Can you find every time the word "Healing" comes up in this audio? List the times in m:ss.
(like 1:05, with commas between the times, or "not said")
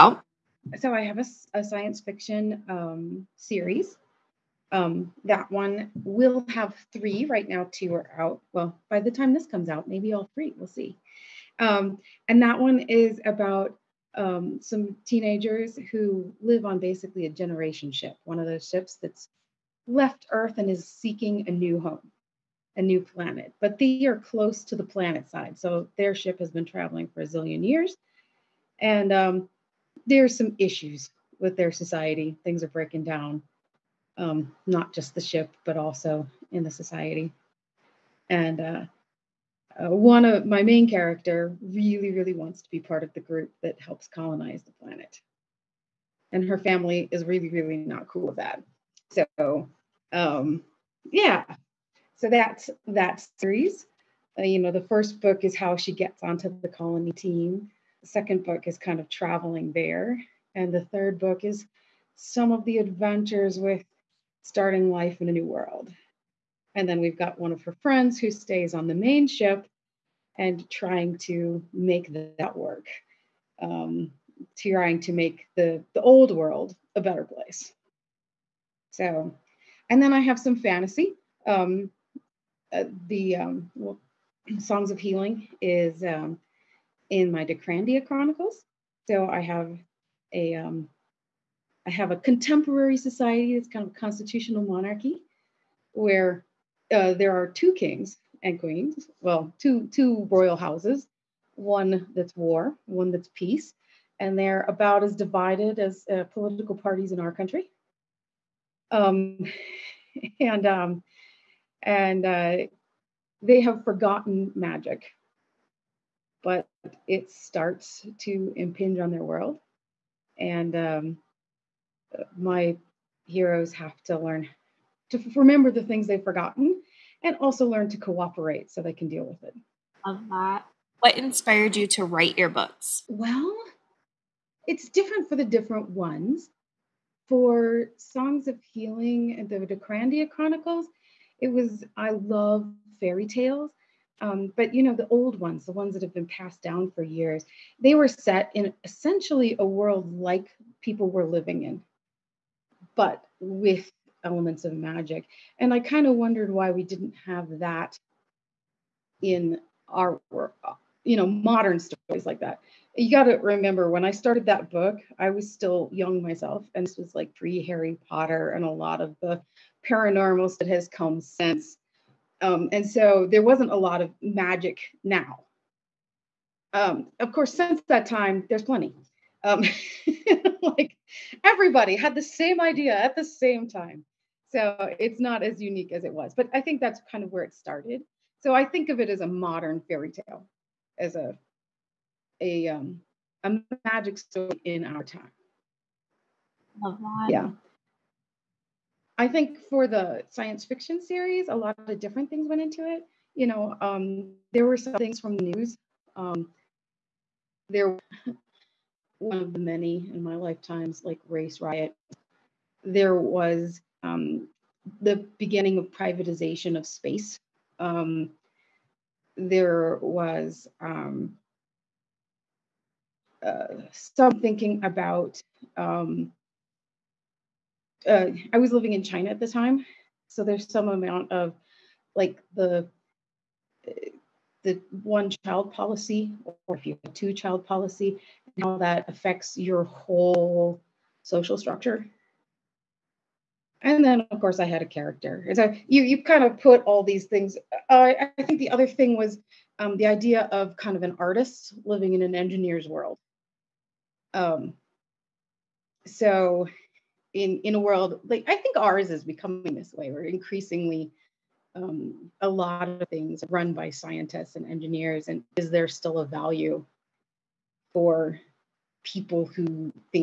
1:24, 2:18.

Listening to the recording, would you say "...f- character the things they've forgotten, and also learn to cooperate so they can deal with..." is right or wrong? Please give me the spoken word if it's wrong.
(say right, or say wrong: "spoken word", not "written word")
wrong: "remember", not "character".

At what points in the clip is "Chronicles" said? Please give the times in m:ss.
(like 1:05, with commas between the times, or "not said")
1:28, 2:20.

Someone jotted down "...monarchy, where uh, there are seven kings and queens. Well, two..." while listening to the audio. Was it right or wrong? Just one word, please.
wrong.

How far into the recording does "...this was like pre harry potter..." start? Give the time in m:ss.
2:46.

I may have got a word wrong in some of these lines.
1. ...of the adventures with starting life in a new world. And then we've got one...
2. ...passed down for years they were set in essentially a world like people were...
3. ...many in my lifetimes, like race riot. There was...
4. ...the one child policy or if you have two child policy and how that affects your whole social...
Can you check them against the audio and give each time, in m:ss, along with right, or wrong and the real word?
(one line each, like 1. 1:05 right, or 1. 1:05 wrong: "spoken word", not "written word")
1. 1:02 right
2. 2:26 right
3. 3:29 right
4. 3:54 right.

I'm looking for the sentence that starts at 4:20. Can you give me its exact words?
We're increasingly um, a lot of things run by scientists and engineers.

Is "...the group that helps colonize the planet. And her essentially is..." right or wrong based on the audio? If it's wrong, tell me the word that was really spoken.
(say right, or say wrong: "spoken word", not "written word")
wrong: "family", not "essentially".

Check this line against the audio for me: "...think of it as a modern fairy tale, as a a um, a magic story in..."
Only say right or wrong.
right.